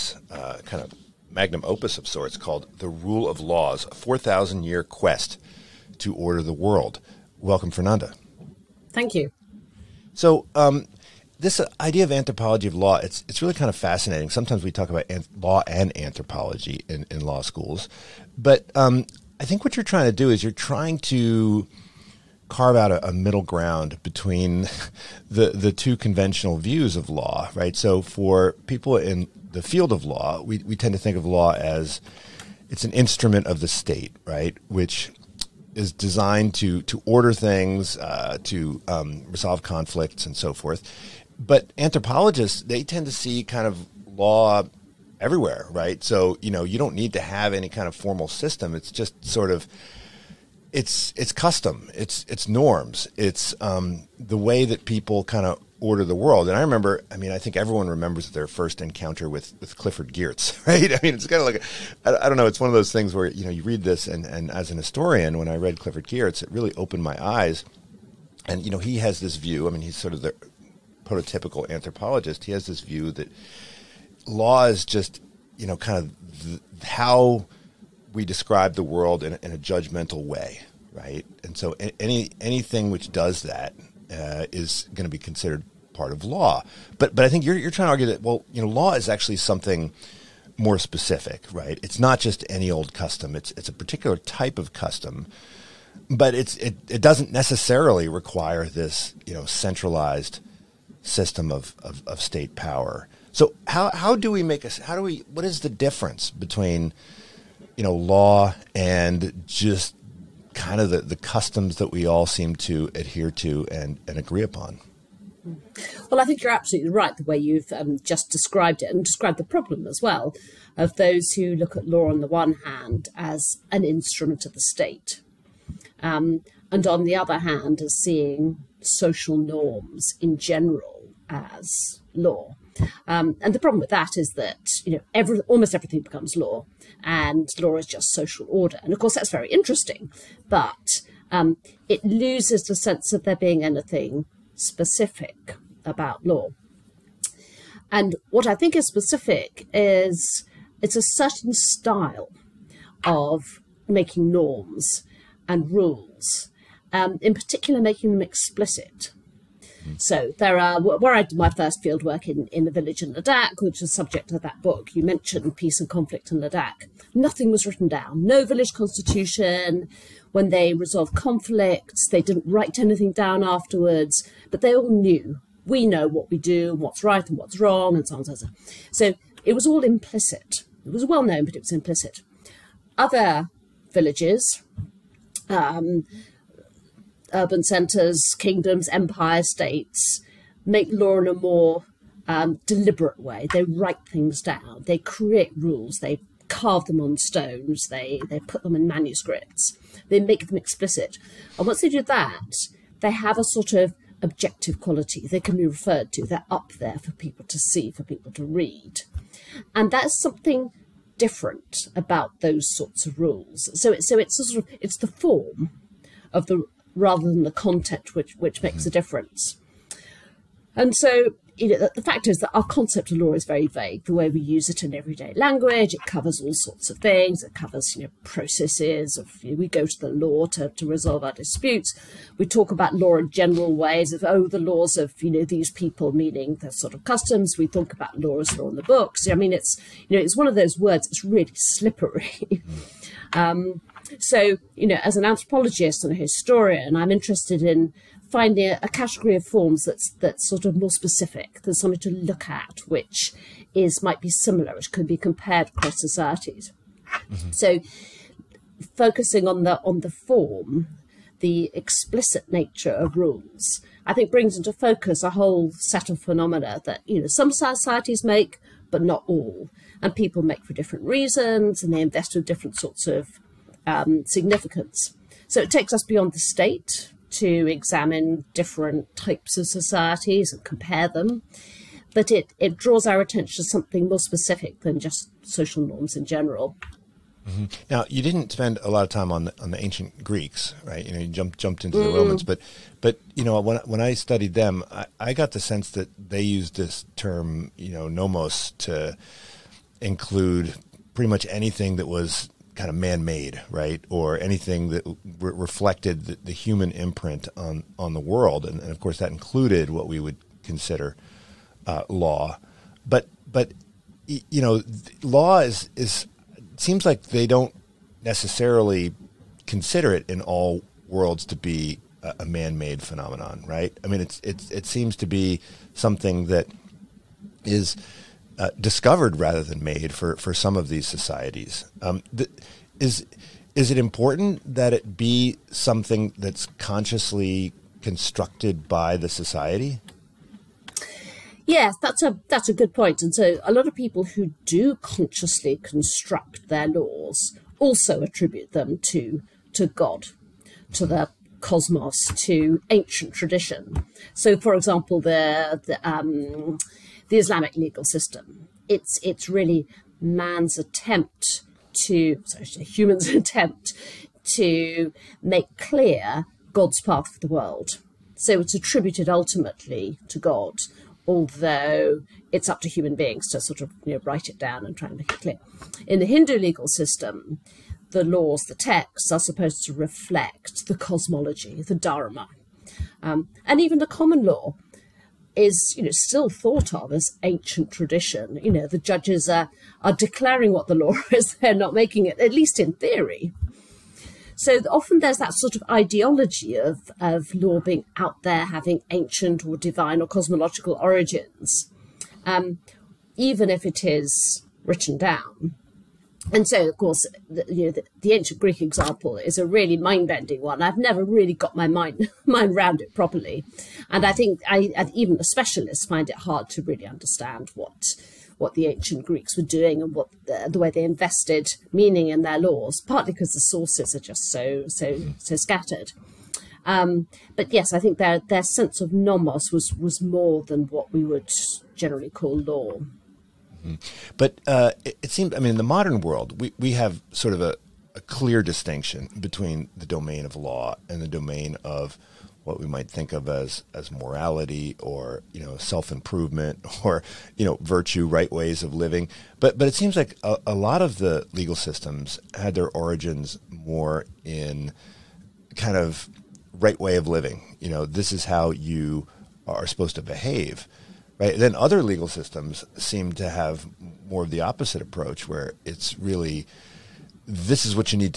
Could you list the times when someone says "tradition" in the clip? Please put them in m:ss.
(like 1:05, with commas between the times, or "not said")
5:53, 6:27.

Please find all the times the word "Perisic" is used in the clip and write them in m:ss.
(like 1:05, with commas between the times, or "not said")
not said.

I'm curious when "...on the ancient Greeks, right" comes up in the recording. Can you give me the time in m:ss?
4:49.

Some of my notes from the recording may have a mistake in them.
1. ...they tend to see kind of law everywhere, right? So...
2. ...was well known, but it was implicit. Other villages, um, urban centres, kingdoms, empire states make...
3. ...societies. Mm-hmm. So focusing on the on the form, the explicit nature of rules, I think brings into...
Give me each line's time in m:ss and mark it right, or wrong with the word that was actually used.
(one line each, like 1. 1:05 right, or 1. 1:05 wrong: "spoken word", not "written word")
1. 0:42 right
2. 3:00 right
3. 4:15 right.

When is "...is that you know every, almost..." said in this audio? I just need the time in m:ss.
2:14.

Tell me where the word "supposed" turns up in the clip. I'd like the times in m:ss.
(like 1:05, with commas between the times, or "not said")
6:19, 7:39.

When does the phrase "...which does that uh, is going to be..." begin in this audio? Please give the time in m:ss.
1:22.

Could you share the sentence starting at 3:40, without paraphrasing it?
And so you know, the fact is that our concept of law is very vague.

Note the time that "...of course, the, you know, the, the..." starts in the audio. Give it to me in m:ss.
6:46.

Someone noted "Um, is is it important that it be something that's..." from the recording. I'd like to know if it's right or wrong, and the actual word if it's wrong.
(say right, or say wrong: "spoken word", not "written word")
right.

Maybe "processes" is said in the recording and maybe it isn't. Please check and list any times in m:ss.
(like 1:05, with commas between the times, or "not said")
3:48.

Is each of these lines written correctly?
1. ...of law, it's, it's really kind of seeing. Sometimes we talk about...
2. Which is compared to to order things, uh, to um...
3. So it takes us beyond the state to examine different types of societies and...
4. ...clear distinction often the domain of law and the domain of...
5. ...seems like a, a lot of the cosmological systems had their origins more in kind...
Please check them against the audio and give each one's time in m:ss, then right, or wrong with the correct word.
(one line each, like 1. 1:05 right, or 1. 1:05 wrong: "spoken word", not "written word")
1. 0:12 wrong: "fascinating", not "seeing"
2. 0:34 wrong: "designed", not "compared"
3. 4:35 right
4. 7:18 wrong: "between", not "often"
5. 7:29 wrong: "legal", not "cosmological".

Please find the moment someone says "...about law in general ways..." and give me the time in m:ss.
3:52.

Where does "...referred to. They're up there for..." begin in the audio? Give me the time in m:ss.
3:25.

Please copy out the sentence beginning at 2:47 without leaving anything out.
Nothing was written down, no village constitution when they resolved conflicts.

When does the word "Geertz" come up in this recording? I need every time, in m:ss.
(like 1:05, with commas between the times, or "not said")
1:00, 1:06.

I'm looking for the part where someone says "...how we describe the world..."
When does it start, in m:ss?
1:16.